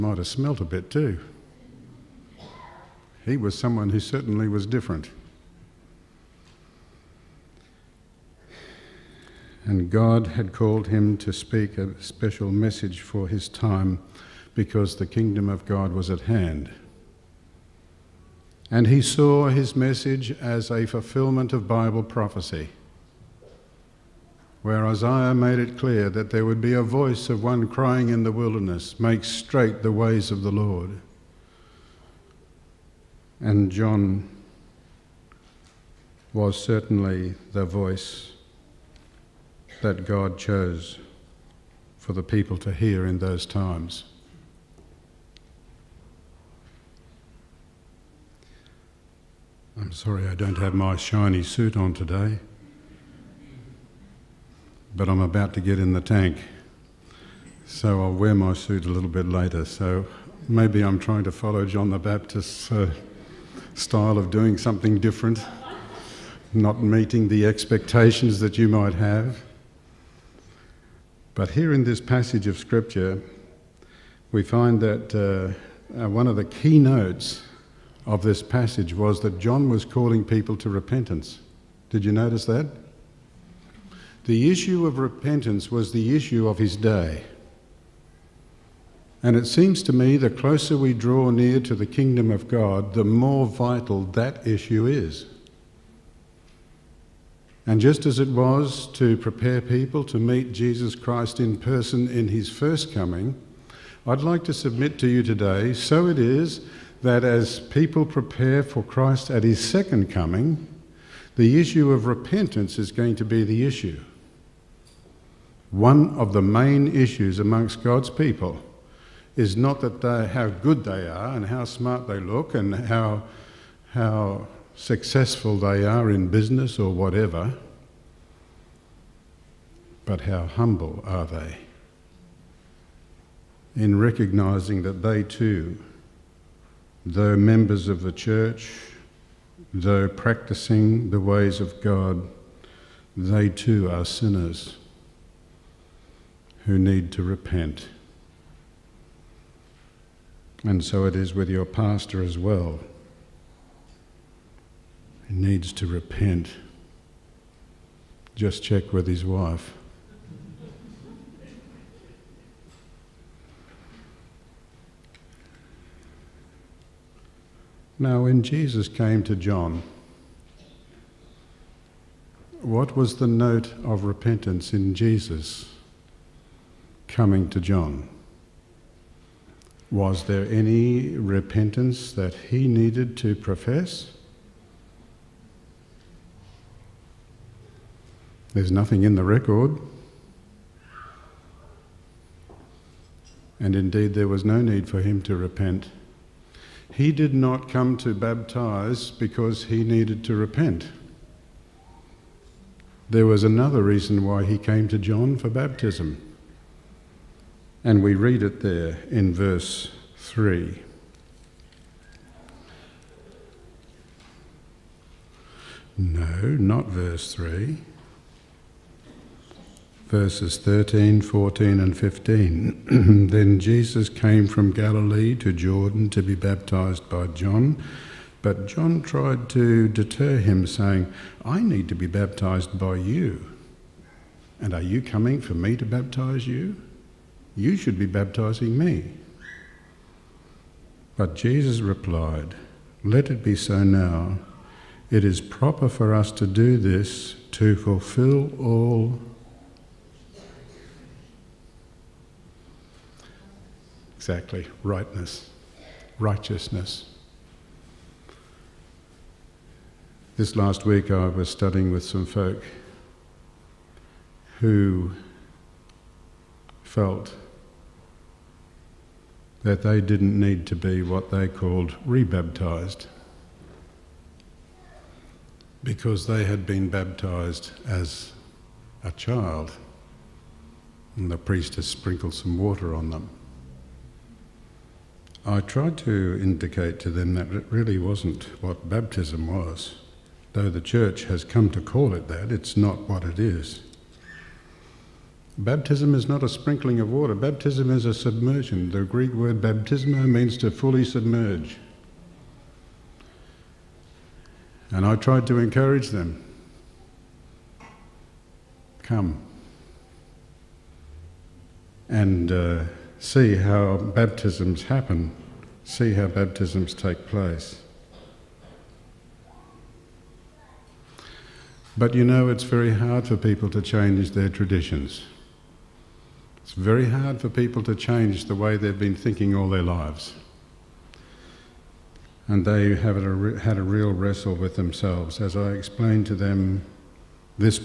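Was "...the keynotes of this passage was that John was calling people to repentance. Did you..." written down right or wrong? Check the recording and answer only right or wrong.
right.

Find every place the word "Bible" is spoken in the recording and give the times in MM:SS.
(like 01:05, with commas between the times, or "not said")
00:21.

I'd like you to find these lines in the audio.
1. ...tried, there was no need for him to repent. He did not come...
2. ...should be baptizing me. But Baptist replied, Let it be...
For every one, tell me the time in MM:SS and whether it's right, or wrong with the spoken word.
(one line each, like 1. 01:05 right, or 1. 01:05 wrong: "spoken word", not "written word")
1. 03:13 wrong: "indeed", not "tried"
2. 03:57 wrong: "Jesus", not "Baptist".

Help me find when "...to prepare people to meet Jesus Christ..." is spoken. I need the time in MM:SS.
01:38.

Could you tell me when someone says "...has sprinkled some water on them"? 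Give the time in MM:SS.
04:41.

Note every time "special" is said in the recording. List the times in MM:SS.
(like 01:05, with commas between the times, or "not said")
00:12.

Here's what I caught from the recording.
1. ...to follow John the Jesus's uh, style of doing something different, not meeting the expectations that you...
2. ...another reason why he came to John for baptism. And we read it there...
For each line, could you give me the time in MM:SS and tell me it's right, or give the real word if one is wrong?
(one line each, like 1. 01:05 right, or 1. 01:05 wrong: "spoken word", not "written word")
1. 01:01 wrong: "Baptist", not "Jesus"
2. 03:23 right.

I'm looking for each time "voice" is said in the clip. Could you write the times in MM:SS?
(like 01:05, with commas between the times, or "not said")
00:26, 00:37.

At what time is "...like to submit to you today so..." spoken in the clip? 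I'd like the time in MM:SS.
01:44.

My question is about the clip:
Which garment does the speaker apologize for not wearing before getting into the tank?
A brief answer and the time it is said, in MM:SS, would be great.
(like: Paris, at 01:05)
shiny suit, at 00:50.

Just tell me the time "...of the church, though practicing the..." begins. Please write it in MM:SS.
02:17.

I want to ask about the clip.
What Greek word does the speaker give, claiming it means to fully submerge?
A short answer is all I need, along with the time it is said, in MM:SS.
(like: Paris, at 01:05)
baptismo, at 04:59.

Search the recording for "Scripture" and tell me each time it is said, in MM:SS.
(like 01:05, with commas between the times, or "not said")
01:12.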